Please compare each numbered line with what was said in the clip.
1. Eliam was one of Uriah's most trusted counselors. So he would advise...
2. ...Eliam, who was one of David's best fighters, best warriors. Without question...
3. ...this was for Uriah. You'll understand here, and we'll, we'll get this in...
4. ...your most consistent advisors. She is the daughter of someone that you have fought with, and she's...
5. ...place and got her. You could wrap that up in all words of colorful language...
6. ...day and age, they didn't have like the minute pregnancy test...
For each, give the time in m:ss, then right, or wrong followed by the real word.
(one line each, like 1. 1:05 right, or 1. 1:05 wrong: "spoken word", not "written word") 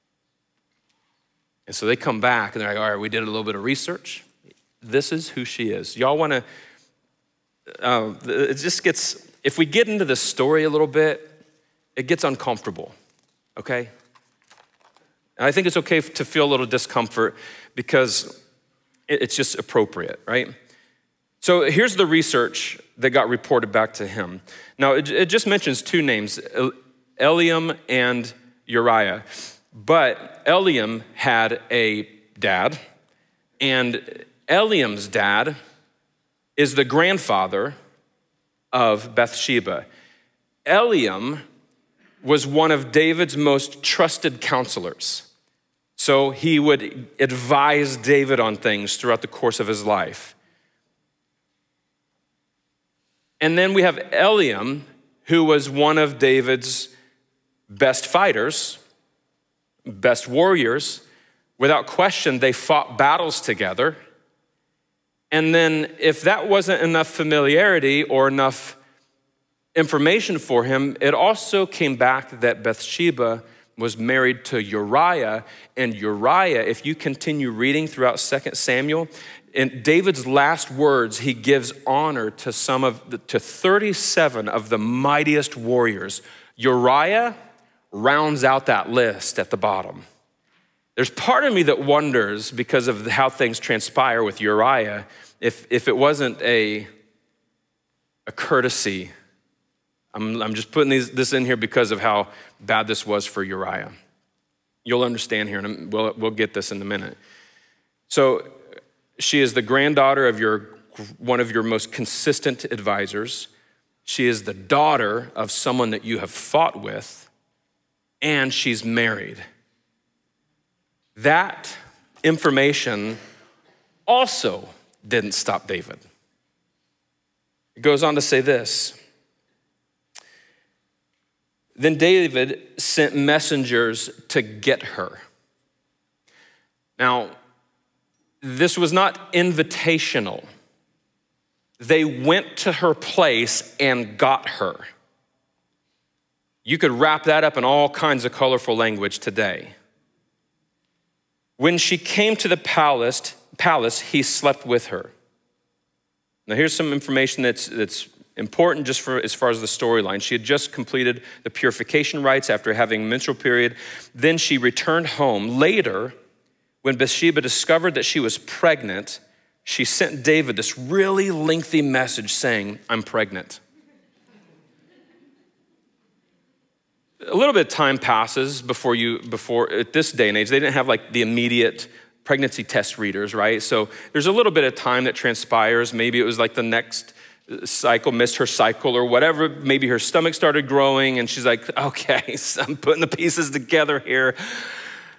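1. 0:40 wrong: "David", not "Uriah"
2. 0:53 right
3. 1:42 right
4. 1:51 right
5. 2:22 wrong: "kinds", not "words"
6. 3:00 wrong: "immediate", not "minute".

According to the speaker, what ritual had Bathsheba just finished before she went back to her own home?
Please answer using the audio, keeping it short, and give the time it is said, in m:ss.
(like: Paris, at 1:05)
purification rites, at 2:41.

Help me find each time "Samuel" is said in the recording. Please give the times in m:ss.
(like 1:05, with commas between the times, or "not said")
1:18.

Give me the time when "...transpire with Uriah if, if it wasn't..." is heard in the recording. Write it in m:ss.
1:33.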